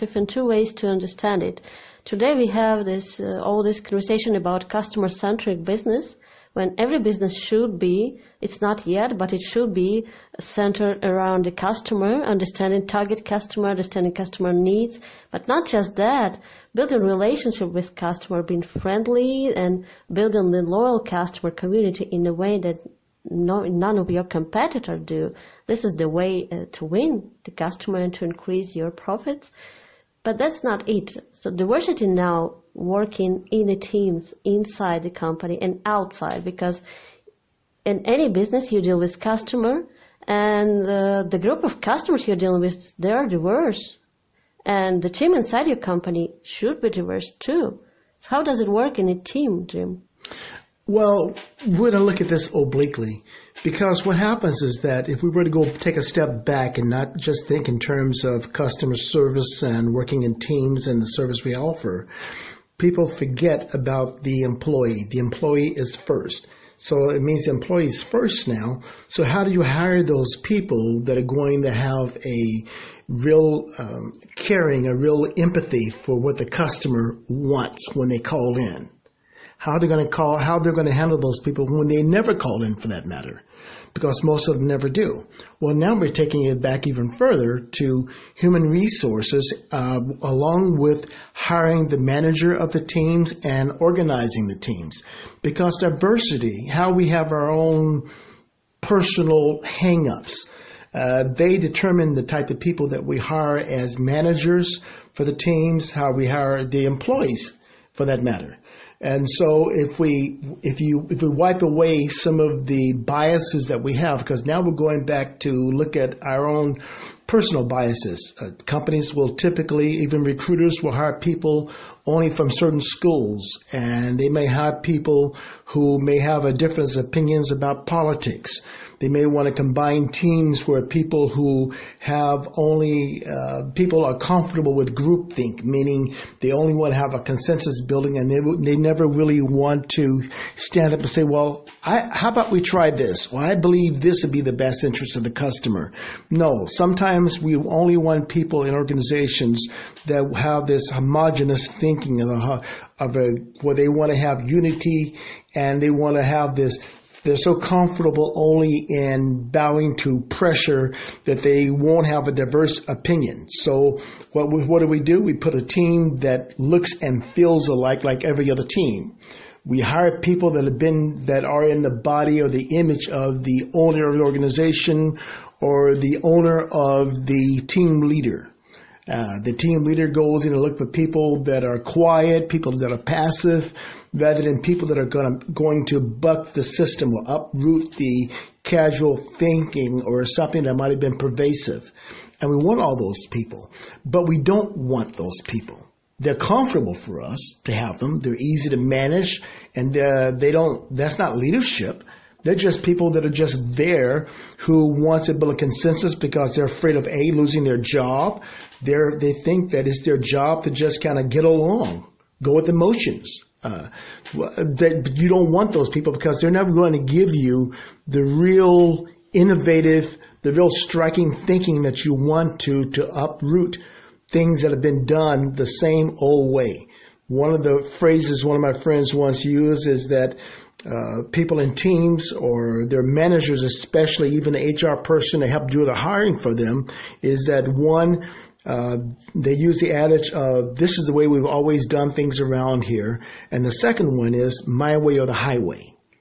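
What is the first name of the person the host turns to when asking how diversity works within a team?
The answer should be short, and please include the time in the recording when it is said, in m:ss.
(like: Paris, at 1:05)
Jim, at 0:49.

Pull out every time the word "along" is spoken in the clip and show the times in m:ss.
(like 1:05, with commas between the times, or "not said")
1:30, 3:31.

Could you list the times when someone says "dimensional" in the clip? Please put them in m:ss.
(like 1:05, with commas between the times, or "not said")
not said.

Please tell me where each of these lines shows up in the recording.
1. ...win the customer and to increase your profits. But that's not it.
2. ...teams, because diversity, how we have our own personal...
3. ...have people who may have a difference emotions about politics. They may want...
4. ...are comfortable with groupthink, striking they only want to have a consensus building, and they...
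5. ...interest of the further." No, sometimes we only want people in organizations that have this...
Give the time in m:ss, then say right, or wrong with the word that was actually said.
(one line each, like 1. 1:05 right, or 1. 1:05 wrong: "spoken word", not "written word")
1. 0:26 right
2. 1:34 right
3. 2:04 wrong: "opinions", not "emotions"
4. 2:14 wrong: "meaning", not "striking"
5. 2:24 wrong: "customer", not "further".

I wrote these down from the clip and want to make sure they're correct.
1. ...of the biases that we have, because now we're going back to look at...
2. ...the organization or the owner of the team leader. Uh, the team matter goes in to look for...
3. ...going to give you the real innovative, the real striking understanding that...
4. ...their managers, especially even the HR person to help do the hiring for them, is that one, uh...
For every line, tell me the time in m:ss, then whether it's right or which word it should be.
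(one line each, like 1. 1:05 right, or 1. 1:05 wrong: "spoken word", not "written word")
1. 1:52 right
2. 2:54 wrong: "leader", not "matter"
3. 3:36 wrong: "thinking", not "understanding"
4. 3:52 right.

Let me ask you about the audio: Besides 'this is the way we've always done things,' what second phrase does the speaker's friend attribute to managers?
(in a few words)
My way or the highway.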